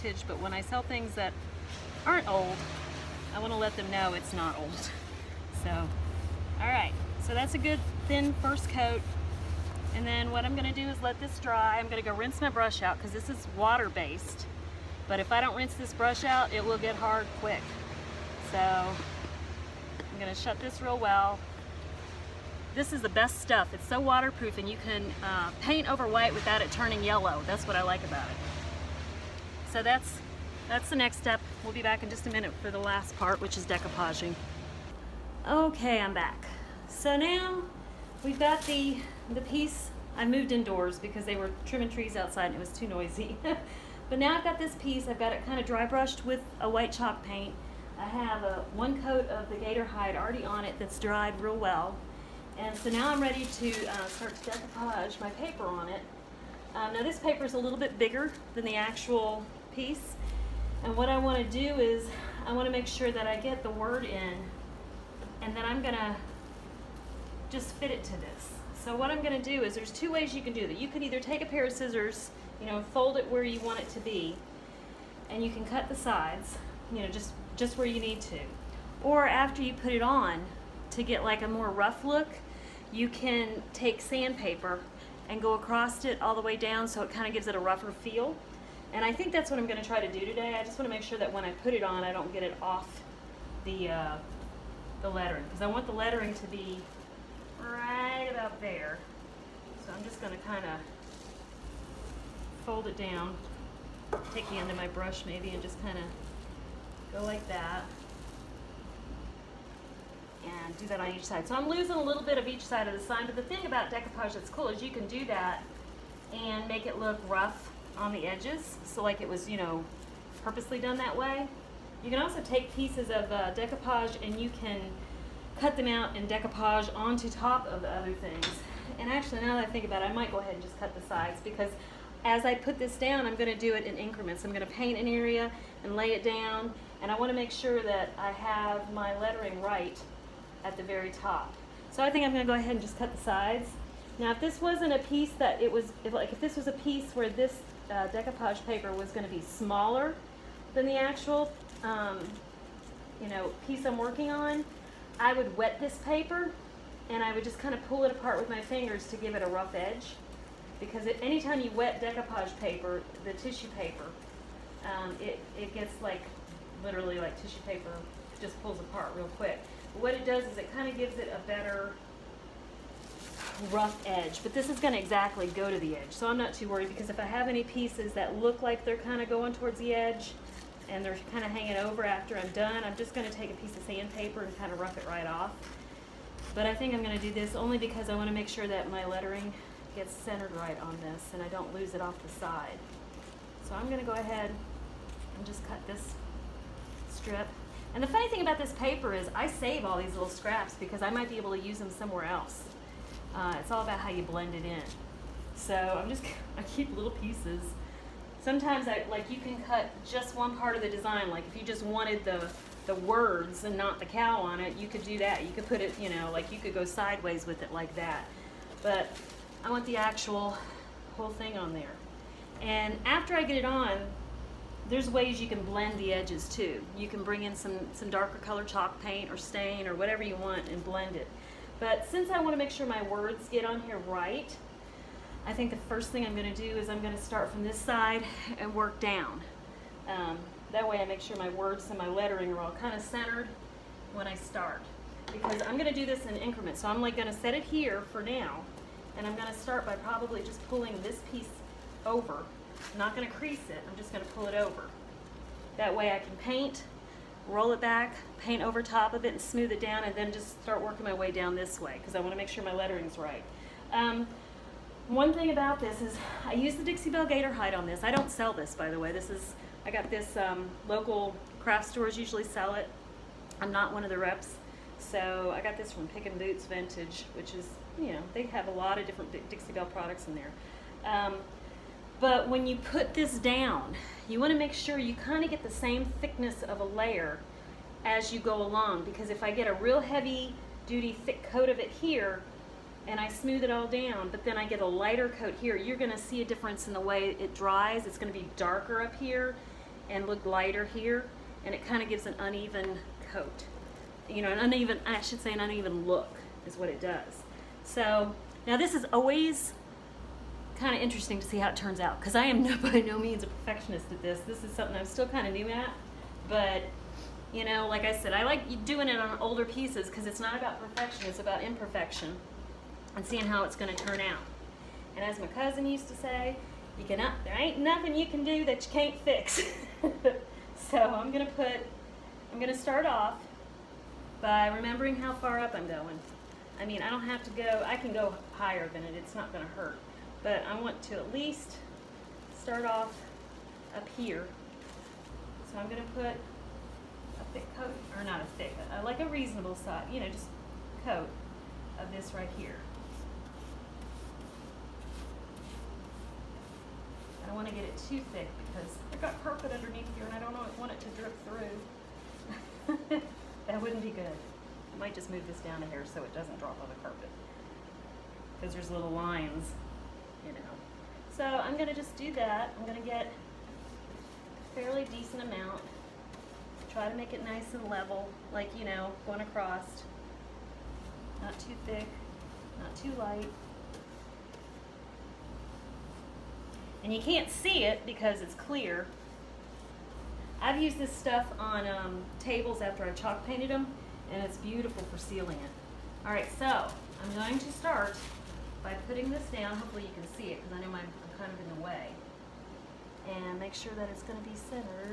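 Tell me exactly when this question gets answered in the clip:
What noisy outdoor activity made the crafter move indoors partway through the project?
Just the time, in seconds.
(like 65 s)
41 s.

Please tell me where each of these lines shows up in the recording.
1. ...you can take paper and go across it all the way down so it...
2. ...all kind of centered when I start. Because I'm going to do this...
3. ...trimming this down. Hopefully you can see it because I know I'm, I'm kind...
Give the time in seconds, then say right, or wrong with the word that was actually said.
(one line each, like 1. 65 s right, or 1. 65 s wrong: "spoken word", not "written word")
1. 82 s wrong: "sandpaper", not "paper"
2. 242 s right
3. 399 s wrong: "putting", not "trimming".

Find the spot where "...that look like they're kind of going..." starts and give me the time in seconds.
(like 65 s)
178 s.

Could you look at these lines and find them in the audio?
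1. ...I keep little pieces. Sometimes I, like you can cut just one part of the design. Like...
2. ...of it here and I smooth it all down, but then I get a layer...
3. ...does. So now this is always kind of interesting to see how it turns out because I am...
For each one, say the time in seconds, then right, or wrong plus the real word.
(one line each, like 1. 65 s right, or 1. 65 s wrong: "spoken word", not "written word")
1. 206 s right
2. 291 s wrong: "lighter", not "layer"
3. 307 s right.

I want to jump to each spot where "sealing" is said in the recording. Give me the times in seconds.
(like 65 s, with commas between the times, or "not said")
395 s.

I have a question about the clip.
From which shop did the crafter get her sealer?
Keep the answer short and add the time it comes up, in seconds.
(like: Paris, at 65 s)
Pick and Boots Vintage, at 276 s.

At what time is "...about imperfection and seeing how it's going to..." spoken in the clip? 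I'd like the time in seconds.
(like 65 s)
321 s.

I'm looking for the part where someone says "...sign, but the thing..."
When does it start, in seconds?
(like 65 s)
112 s.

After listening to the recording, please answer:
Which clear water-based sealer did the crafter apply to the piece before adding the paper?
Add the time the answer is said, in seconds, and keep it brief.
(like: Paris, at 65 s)
Dixie Belle Gator Hide, at 266 s.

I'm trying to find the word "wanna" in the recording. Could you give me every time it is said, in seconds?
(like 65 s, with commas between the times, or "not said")
262 s, 357 s.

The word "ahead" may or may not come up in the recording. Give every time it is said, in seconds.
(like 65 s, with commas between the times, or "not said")
130 s, 142 s, 194 s.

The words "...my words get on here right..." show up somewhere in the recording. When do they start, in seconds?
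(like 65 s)
232 s.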